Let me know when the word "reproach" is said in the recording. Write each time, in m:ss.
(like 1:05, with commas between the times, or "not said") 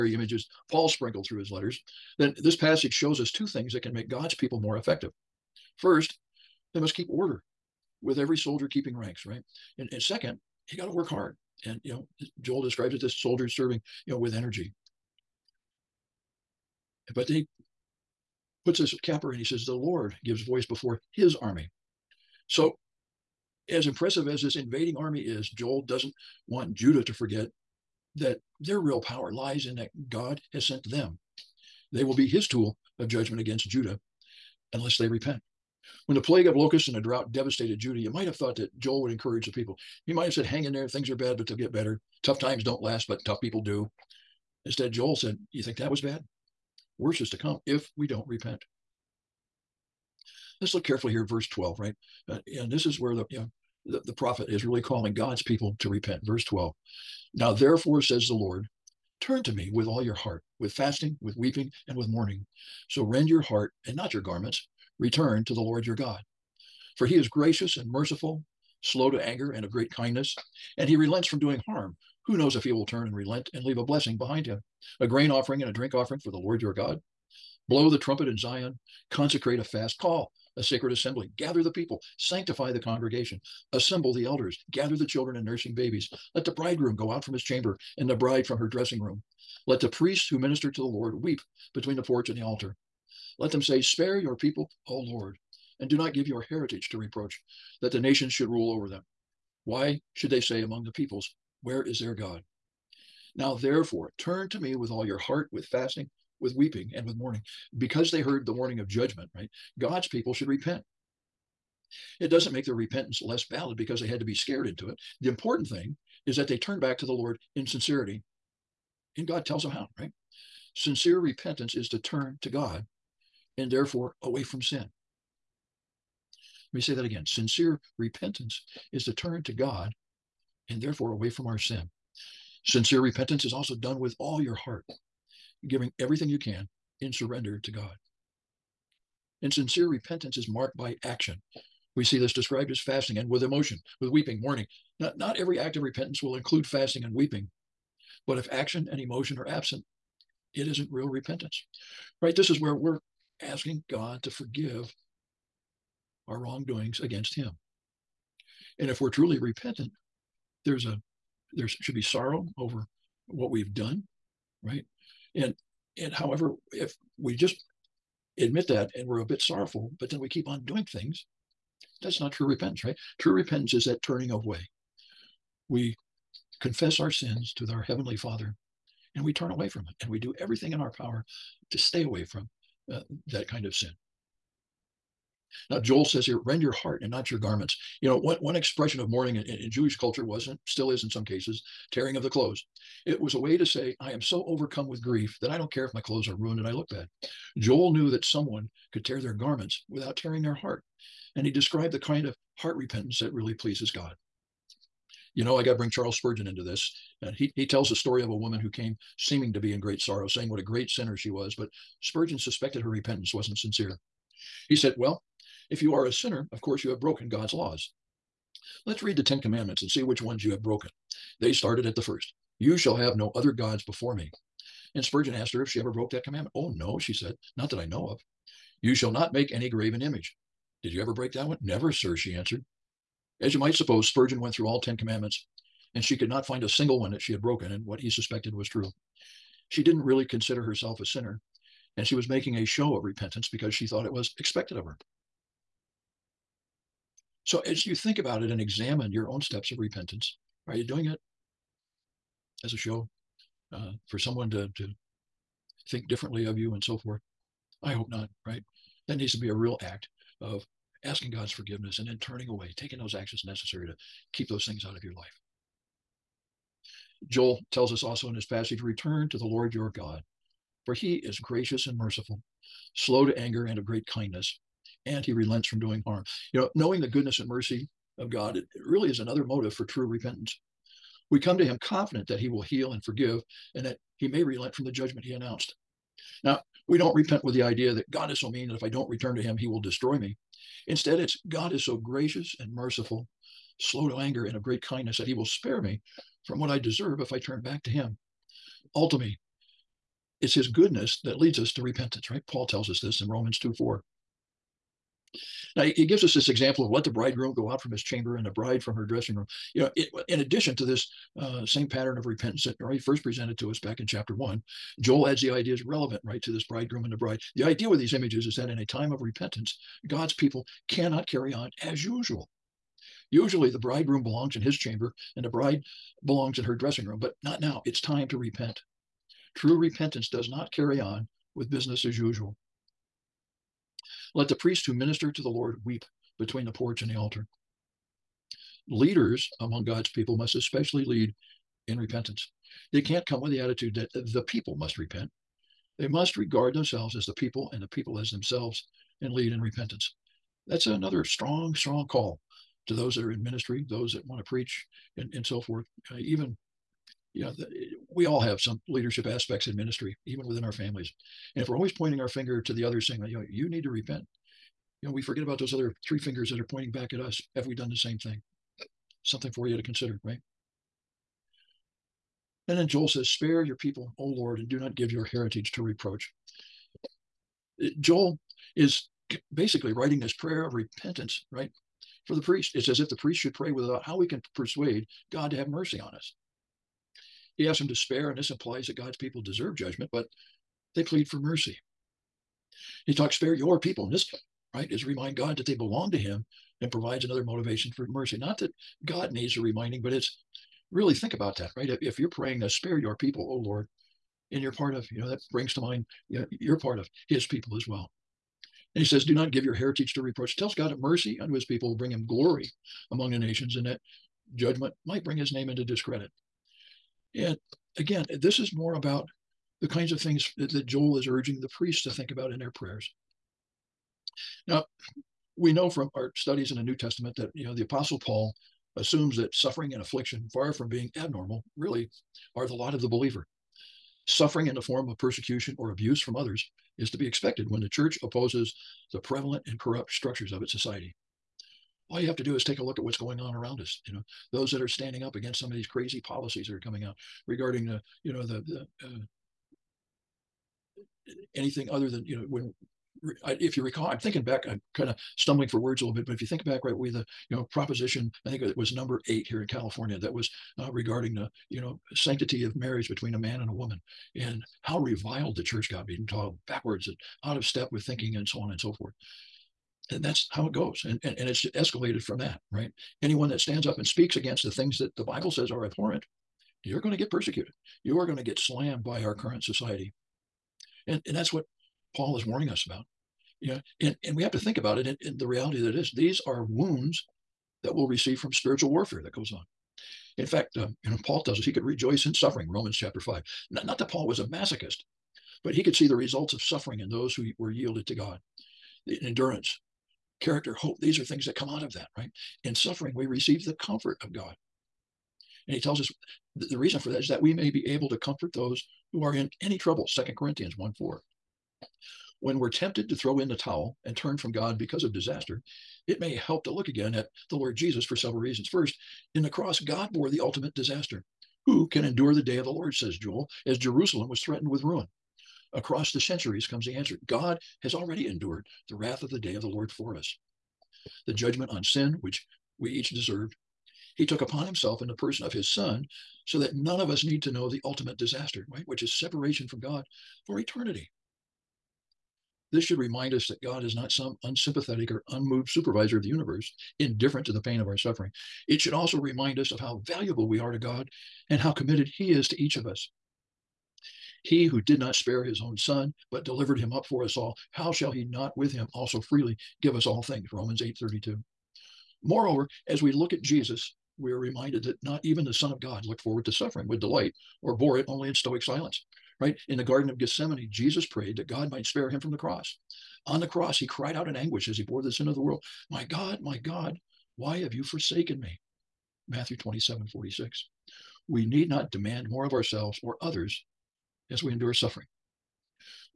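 1:36, 6:15, 6:50.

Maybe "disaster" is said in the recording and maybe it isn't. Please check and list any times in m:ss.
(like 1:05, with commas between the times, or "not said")
8:35, 8:40, 8:58.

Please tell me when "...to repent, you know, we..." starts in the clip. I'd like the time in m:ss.
6:03.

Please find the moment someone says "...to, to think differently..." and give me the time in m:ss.
4:14.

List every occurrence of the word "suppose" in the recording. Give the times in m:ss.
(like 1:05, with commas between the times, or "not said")
3:53.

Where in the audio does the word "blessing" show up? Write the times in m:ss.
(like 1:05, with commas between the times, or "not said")
1:13.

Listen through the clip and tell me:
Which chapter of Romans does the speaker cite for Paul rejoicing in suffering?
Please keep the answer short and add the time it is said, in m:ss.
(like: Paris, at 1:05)
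Chapter 5, at 8:12.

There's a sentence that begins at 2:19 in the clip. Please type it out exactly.
And sincere repentance is marked by action.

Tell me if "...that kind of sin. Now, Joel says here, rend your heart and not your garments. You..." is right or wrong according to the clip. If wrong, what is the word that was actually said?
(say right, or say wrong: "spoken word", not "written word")
right.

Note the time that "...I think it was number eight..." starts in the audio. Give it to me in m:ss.
7:38.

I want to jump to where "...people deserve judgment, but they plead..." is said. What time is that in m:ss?
6:29.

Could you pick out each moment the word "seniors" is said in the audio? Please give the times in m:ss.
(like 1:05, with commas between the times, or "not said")
not said.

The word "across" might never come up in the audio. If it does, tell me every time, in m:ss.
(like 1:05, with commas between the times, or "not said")
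8:45.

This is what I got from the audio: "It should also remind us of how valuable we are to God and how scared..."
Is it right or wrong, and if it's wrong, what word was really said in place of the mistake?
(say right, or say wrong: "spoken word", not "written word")
wrong: "committed", not "scared".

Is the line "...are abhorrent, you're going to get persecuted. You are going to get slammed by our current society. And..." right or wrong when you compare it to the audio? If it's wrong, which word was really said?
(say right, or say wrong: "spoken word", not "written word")
right.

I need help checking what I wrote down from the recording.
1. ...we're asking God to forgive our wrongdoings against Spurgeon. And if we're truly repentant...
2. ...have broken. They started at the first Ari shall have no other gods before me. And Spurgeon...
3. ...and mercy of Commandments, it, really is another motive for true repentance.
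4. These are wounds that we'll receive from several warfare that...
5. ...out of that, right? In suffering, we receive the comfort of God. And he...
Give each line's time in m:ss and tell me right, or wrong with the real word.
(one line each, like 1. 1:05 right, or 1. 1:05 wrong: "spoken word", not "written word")
1. 2:32 wrong: "Him", not "Spurgeon"
2. 3:40 wrong: "You", not "Ari"
3. 4:37 wrong: "God", not "Commandments"
4. 8:06 wrong: "spiritual", not "several"
5. 8:21 right.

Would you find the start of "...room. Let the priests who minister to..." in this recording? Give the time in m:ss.
1:29.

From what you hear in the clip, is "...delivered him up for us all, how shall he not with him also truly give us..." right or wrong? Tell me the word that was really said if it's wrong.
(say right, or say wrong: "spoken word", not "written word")
wrong: "freely", not "truly".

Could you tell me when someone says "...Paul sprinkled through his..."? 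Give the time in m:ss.
0:00.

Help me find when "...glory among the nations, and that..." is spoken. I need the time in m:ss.
6:52.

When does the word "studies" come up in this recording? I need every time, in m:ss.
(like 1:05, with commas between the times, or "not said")
7:06.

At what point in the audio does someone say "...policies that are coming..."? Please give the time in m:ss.
7:26.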